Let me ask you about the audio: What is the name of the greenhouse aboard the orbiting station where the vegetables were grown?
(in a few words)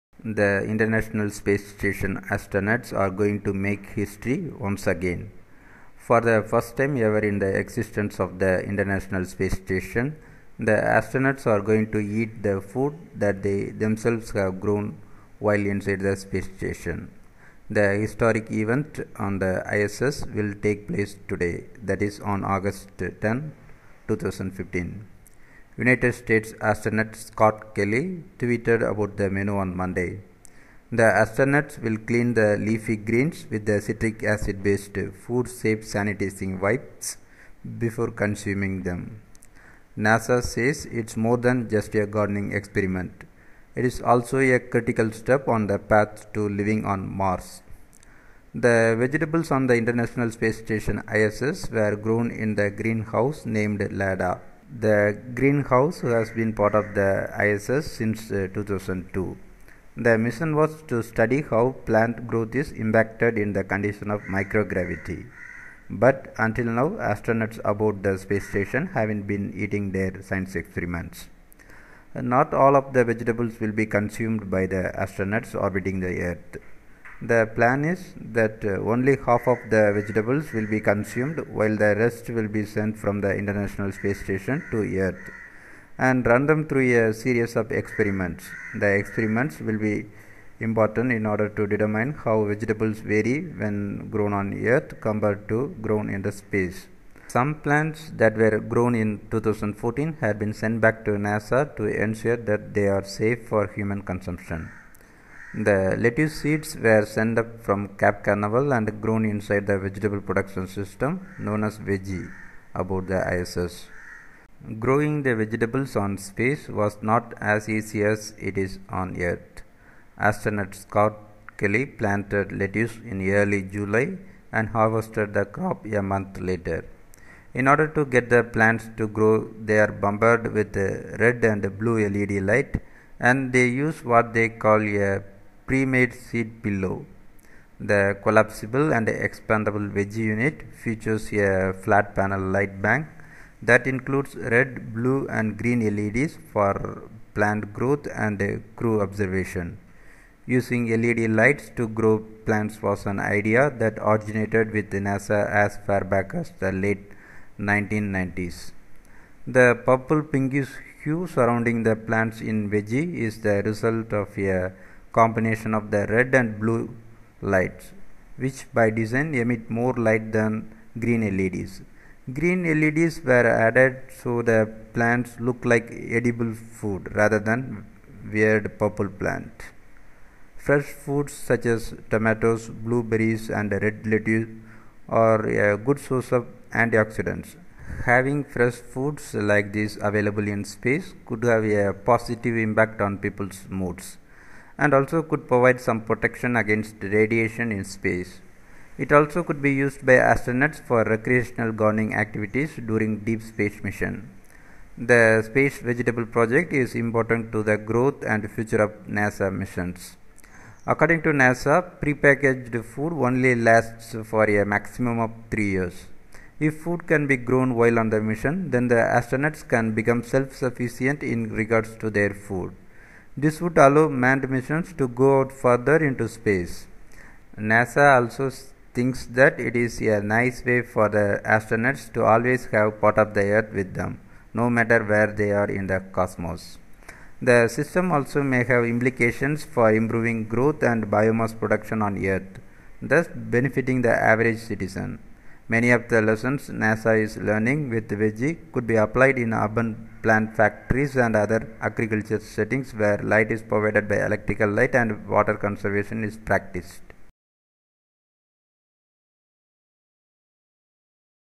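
LADA.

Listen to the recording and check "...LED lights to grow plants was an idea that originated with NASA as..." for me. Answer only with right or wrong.
right.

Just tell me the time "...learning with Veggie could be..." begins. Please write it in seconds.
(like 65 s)
247 s.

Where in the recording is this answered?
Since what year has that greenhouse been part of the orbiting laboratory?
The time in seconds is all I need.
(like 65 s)
58 s.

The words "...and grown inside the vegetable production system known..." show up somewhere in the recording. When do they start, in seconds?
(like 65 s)
108 s.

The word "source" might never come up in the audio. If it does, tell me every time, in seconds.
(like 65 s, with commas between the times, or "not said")
185 s.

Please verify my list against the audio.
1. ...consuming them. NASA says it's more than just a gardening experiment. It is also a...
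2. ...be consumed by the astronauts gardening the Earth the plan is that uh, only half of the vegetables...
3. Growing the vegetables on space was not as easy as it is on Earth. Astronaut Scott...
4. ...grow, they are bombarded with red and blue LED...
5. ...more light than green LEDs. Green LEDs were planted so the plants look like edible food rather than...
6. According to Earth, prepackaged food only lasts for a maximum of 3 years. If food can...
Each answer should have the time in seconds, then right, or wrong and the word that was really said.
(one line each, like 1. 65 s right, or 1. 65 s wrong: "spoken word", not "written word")
1. 38 s right
2. 73 s wrong: "orbiting", not "gardening"
3. 114 s right
4. 129 s right
5. 169 s wrong: "added", not "planted"
6. 210 s wrong: "NASA", not "Earth".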